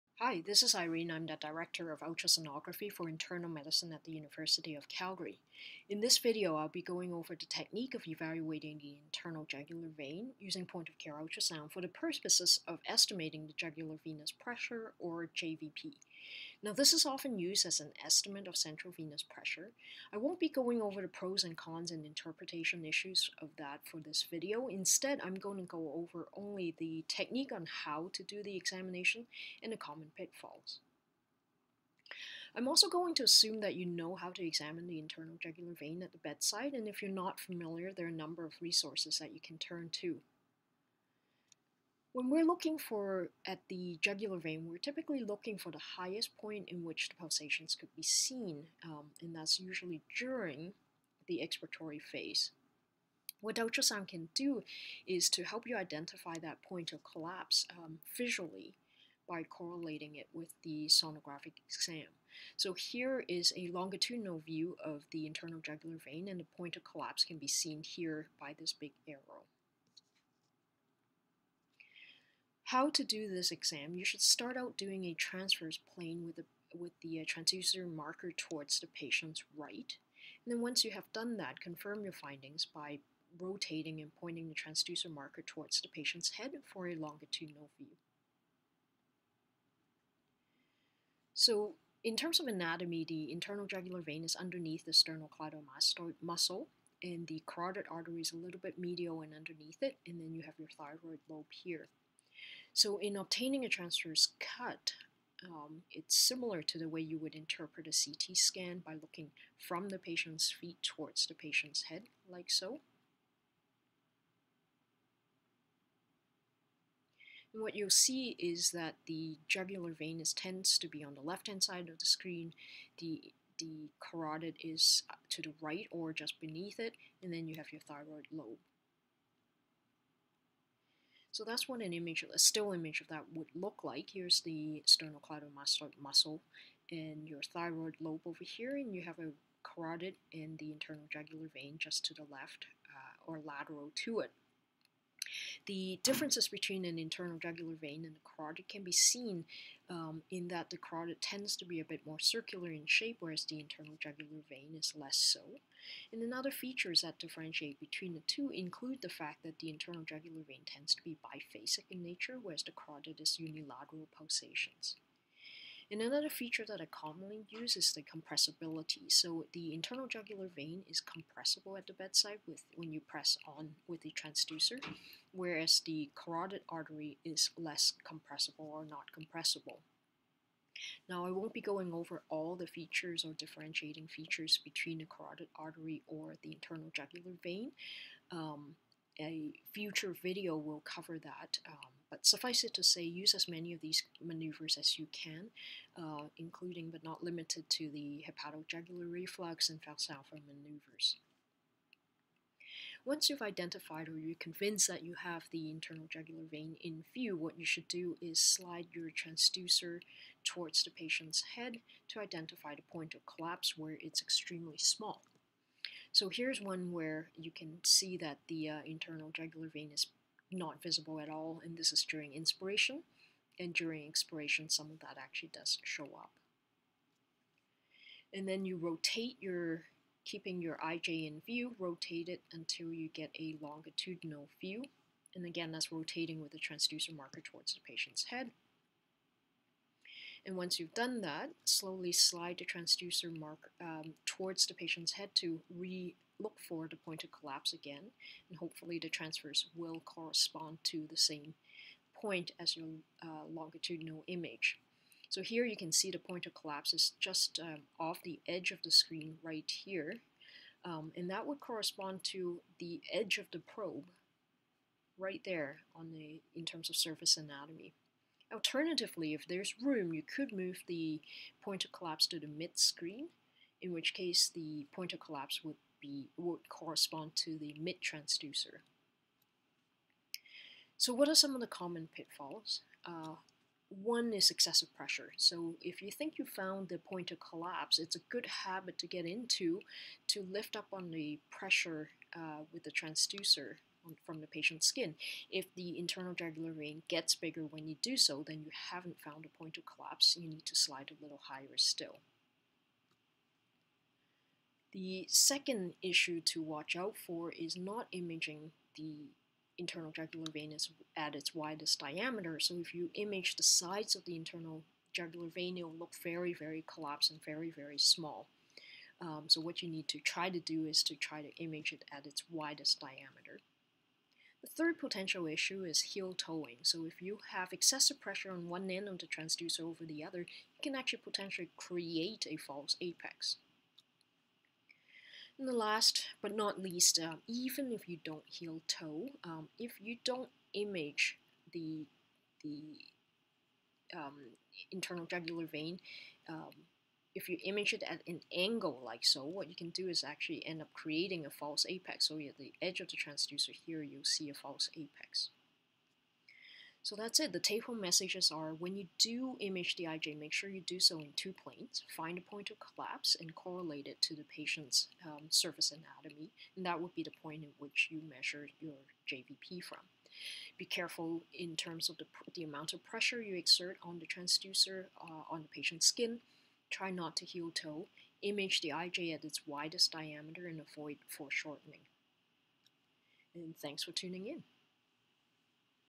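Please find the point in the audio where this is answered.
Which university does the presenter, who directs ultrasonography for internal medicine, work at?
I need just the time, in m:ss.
0:04.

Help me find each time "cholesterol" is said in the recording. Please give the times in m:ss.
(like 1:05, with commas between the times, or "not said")
not said.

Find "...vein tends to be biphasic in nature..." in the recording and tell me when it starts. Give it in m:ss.
2:40.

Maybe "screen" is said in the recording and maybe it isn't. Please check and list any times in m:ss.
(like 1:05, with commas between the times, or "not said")
2:02, 4:18, 4:32.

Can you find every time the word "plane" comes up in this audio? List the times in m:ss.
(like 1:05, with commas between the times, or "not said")
1:15, 6:01.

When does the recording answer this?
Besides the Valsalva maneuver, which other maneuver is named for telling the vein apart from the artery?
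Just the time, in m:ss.
3:18.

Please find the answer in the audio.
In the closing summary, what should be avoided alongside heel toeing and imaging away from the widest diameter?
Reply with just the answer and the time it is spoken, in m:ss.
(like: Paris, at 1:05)
Foreshortening, at 6:21.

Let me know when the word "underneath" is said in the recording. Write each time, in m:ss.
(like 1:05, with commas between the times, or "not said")
1:34, 1:39.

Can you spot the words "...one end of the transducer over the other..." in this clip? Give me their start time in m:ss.
5:28.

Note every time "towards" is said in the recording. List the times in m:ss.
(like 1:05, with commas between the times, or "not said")
1:18, 1:25, 1:50, 3:30, 3:57, 4:04.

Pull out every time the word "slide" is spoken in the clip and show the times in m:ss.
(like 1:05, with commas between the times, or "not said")
3:28, 4:02, 5:00.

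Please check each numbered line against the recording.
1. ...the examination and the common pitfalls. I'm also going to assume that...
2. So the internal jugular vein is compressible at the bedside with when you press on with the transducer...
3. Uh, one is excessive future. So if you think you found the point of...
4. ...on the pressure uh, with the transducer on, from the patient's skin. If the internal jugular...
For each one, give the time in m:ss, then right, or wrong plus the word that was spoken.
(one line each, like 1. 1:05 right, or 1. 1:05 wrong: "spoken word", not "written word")
1. 0:28 right
2. 2:49 right
3. 4:43 wrong: "pressure", not "future"
4. 4:50 right.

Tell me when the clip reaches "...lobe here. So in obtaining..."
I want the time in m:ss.
1:41.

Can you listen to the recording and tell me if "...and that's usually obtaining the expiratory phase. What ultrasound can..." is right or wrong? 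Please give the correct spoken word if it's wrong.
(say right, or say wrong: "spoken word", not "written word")
wrong: "during", not "obtaining".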